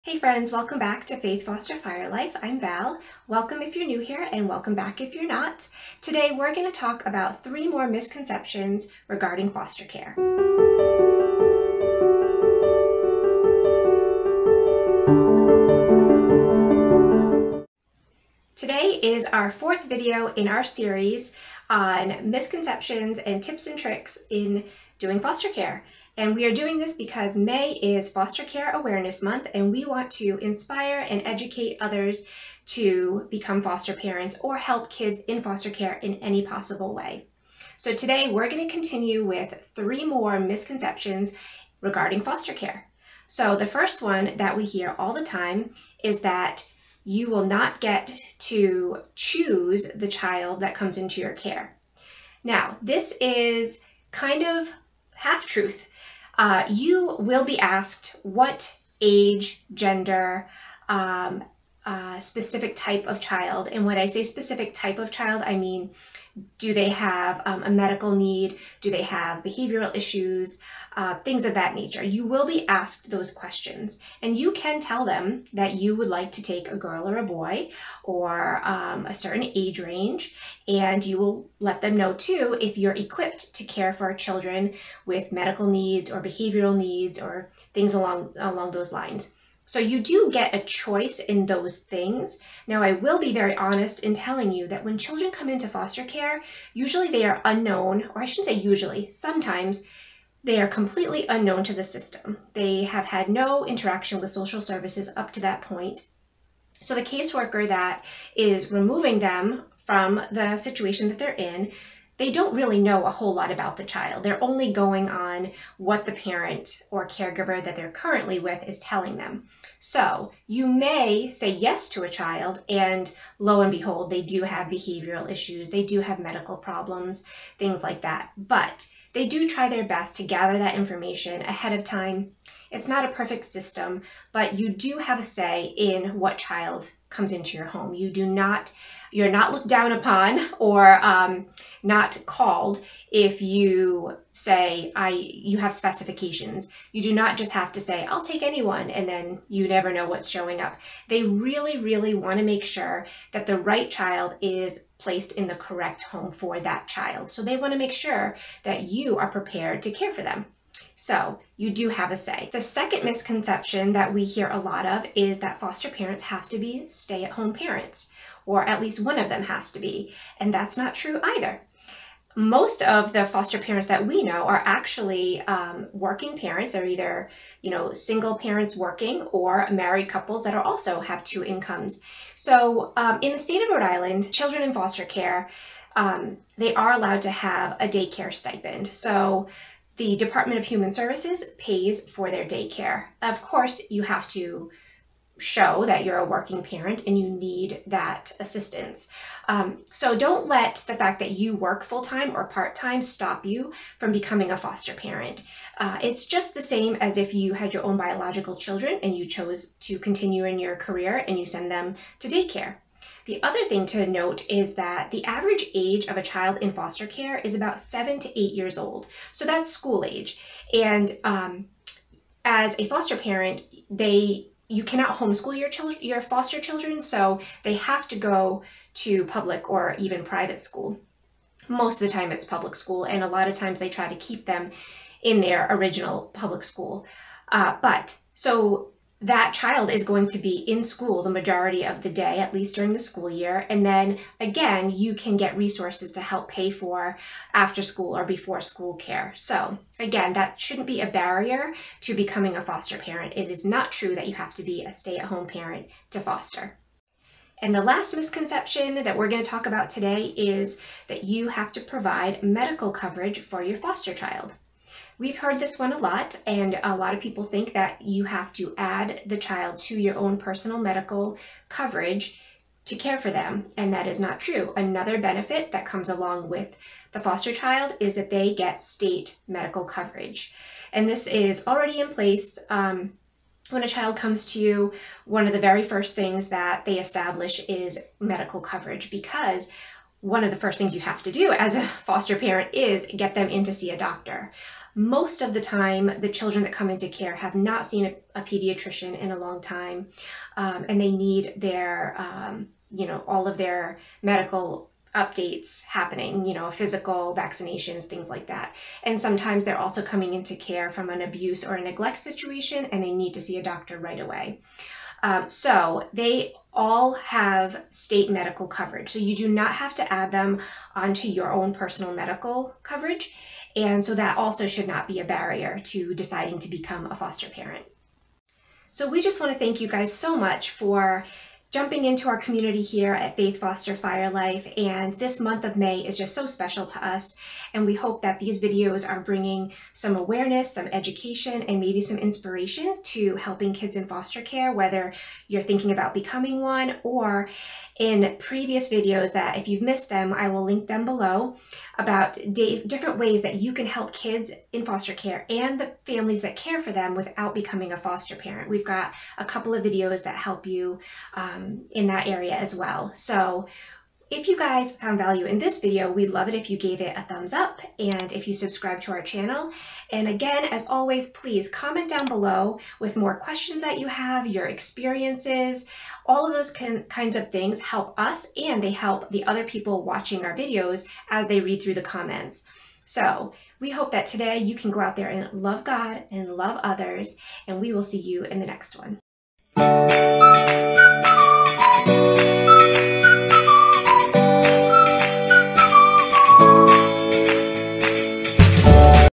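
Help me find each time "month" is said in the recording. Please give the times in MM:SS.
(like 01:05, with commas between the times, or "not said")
00:29, 05:35.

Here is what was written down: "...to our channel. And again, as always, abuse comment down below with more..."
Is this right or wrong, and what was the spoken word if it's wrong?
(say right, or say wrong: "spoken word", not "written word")
wrong: "please", not "abuse".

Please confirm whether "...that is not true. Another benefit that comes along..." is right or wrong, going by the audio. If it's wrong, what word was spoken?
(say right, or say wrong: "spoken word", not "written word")
right.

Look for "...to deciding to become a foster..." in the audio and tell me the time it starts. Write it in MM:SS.
05:25.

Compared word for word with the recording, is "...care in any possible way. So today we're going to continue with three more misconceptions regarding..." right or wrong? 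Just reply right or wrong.
right.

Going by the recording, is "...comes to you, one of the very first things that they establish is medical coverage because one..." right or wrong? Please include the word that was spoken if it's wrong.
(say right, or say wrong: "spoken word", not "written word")
right.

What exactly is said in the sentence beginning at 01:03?
And when I say specific type of child, I mean do they have um, a medical need?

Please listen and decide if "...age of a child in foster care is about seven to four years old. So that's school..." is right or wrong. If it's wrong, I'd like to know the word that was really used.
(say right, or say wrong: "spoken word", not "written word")
wrong: "eight", not "four".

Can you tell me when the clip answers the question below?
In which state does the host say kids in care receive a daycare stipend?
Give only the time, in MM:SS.
03:03.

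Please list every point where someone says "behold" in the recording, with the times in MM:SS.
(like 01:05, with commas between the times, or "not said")
02:03.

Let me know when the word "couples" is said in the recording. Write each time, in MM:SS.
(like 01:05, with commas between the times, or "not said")
03:00, 05:59.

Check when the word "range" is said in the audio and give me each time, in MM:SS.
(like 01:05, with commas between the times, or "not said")
01:19.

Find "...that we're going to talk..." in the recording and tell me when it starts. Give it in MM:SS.
04:19.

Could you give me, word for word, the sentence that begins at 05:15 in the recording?
Um, so they all have state medical coverage.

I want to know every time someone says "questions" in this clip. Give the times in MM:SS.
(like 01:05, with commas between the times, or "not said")
01:13, 06:13.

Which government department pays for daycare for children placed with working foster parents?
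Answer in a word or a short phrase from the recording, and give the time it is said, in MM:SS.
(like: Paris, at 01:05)
Department of Human Services, at 03:10.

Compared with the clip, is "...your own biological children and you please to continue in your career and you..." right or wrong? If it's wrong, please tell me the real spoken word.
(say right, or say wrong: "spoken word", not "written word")
wrong: "chose", not "please".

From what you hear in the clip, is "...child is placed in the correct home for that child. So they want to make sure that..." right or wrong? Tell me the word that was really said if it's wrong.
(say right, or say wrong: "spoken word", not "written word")
right.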